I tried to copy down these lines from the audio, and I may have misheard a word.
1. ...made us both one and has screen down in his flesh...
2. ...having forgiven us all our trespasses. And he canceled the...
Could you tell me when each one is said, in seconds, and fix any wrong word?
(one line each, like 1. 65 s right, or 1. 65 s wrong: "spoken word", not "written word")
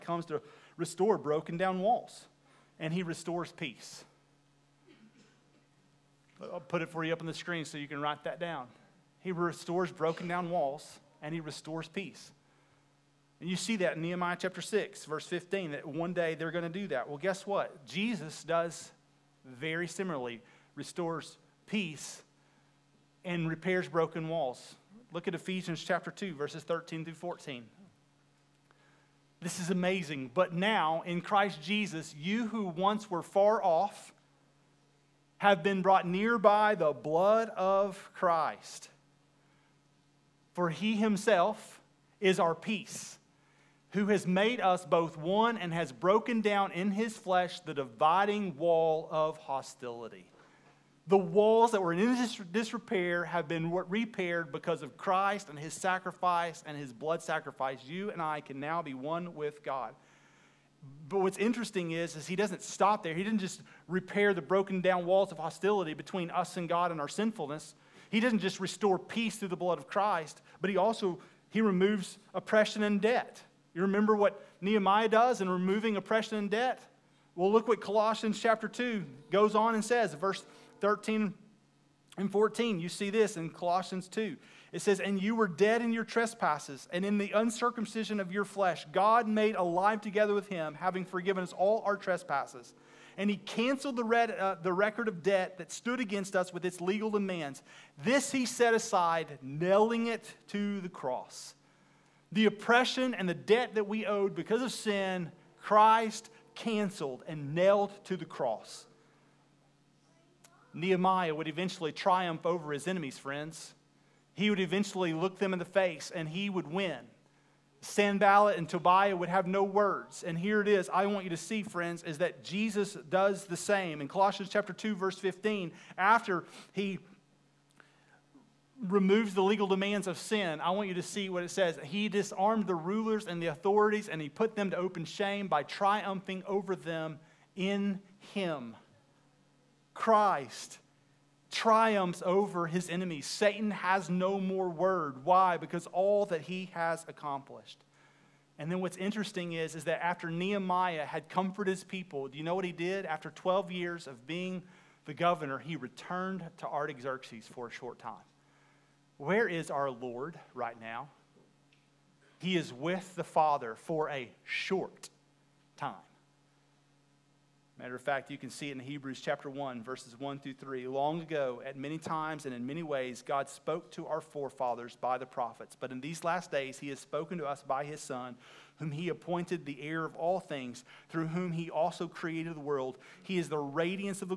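1. 44 s wrong: "broken", not "screen"
2. 90 s right.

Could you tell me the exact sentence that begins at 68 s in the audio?
He doesn't just restore peace through the blood of Christ, but he also he removes oppression and debt.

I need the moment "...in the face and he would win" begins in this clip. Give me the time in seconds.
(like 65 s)
115 s.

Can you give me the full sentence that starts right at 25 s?
Look at Ephesians chapter 2, verses 13 through 14.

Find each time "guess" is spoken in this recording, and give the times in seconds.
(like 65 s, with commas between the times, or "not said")
17 s.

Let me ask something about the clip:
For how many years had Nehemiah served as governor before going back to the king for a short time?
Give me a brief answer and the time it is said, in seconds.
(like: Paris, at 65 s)
12, at 153 s.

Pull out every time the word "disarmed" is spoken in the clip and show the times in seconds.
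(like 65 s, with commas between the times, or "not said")
132 s.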